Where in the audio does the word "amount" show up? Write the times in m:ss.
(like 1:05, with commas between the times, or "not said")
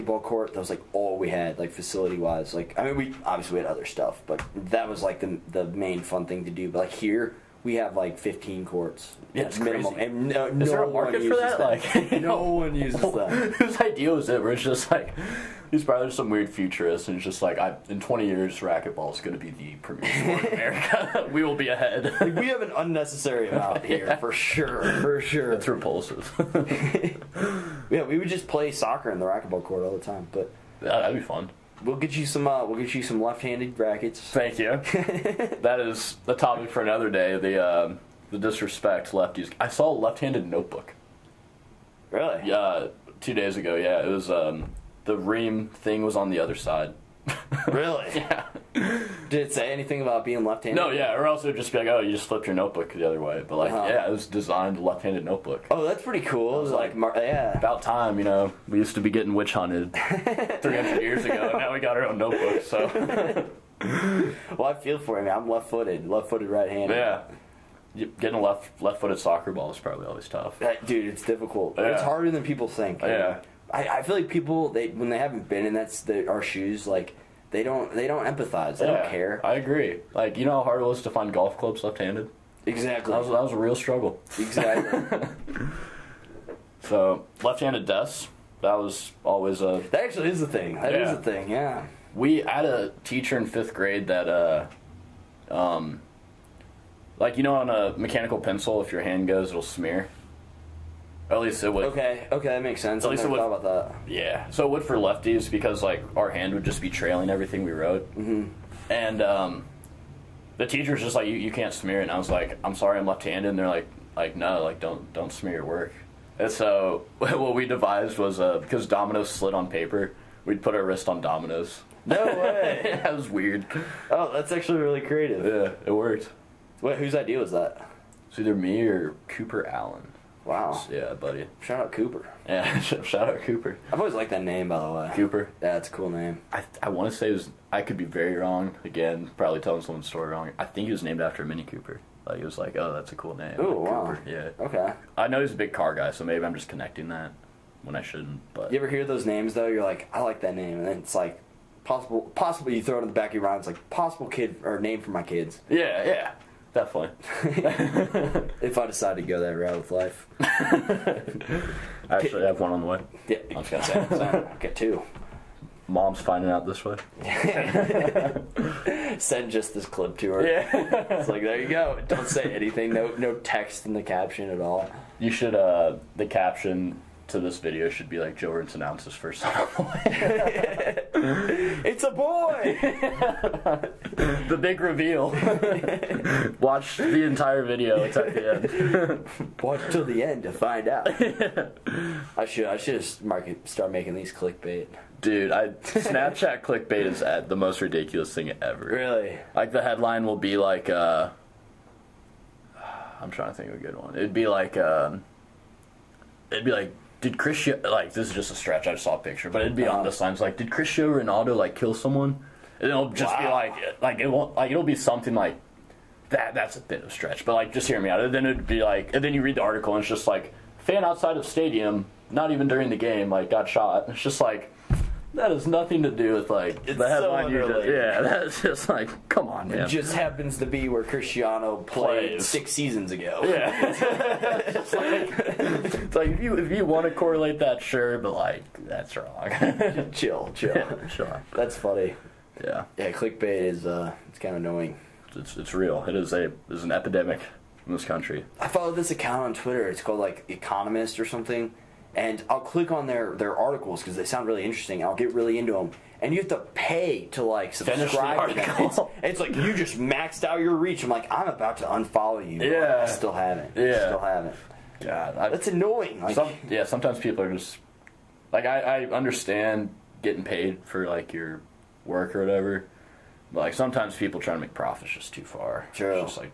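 0:23.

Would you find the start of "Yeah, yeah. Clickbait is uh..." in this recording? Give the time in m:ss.
4:02.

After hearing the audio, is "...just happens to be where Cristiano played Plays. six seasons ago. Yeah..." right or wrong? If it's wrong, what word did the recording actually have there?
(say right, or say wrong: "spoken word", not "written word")
right.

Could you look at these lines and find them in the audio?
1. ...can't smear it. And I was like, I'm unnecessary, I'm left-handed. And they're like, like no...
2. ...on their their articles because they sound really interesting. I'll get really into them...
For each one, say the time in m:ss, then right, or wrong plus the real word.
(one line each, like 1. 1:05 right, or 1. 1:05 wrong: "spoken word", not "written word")
1. 1:51 wrong: "sorry", not "unnecessary"
2. 4:12 right.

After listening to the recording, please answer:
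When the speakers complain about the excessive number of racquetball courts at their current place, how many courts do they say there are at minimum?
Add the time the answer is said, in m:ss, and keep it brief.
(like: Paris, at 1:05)
15, at 0:08.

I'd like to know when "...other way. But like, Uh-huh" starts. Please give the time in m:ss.
0:53.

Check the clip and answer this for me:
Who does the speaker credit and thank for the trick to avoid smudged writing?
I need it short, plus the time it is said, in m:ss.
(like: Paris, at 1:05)
Cooper Allen, at 2:09.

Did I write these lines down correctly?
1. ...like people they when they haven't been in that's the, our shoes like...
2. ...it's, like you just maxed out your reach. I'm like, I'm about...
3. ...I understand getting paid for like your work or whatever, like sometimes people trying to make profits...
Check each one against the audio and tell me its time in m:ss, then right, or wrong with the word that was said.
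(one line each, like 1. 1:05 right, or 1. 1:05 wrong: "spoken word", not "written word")
1. 1:14 right
2. 4:19 right
3. 4:29 right.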